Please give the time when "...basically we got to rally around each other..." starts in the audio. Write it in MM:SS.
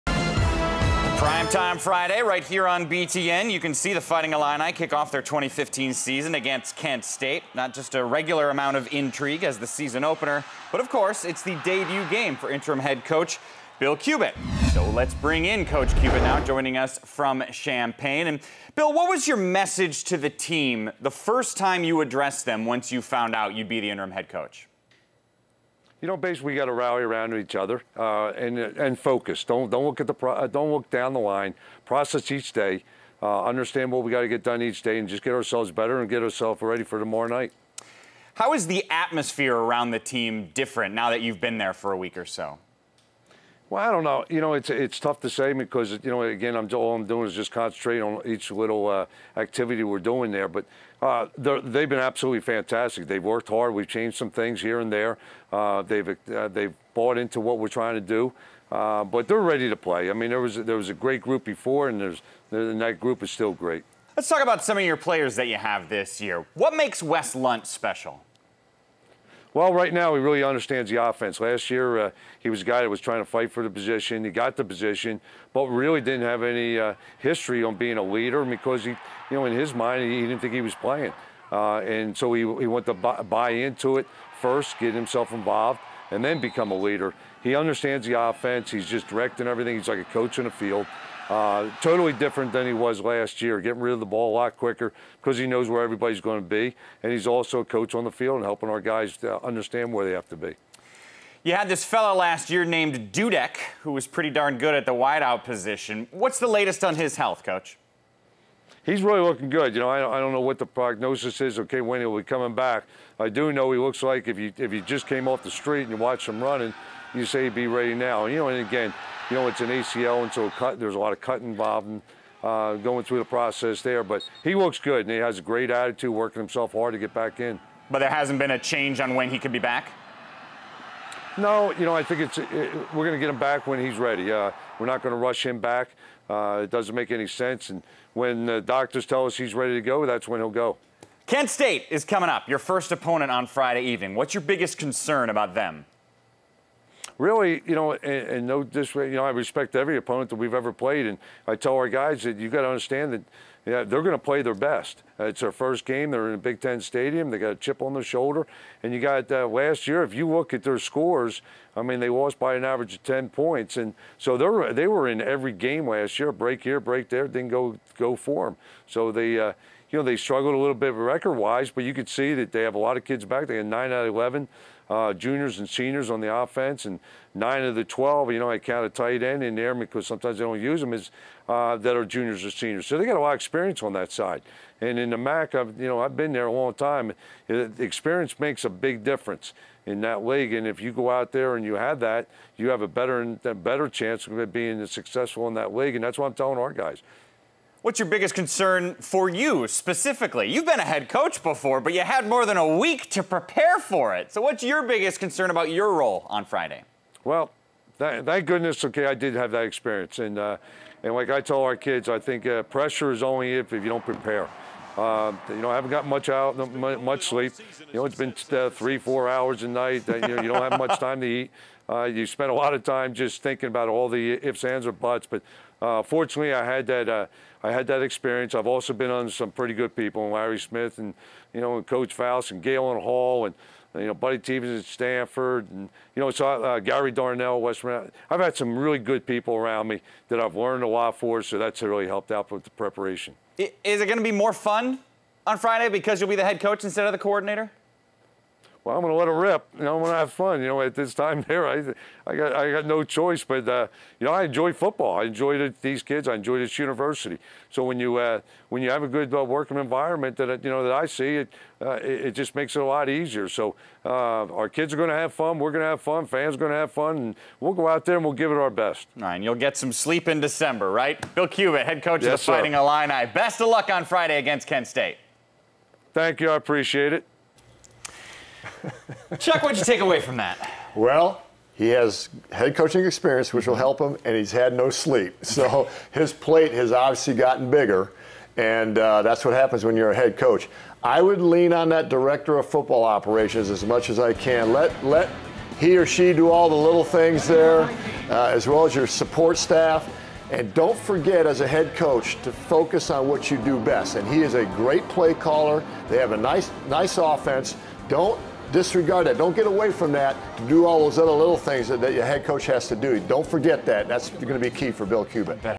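00:26.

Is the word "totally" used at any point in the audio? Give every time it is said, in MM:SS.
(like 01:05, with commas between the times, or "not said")
01:31.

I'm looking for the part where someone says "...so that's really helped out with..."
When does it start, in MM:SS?
04:01.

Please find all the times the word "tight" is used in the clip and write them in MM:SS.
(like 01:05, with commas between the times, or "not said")
02:58.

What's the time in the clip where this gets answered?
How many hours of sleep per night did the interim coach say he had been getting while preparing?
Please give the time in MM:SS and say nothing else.
03:38.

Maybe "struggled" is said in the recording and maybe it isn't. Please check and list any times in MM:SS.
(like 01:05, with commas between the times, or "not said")
02:50.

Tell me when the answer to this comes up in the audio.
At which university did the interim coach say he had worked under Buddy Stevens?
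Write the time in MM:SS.
03:54.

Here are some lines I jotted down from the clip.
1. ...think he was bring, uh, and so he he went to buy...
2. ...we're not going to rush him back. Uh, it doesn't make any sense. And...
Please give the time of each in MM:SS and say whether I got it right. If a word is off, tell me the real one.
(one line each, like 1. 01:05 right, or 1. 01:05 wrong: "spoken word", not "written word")
1. 01:20 wrong: "playing", not "bring"
2. 02:14 right.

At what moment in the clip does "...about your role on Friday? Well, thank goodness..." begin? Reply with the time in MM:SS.
03:25.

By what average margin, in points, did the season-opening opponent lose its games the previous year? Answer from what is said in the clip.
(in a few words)
10.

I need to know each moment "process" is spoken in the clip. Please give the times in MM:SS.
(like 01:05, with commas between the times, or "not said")
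00:31, 02:03.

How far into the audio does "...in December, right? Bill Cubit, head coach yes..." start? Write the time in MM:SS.
04:30.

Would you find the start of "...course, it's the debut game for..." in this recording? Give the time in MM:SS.
00:10.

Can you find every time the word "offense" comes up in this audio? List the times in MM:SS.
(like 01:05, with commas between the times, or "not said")
01:11, 01:28, 02:56, 05:07.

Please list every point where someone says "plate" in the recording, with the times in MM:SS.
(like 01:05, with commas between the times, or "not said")
04:46.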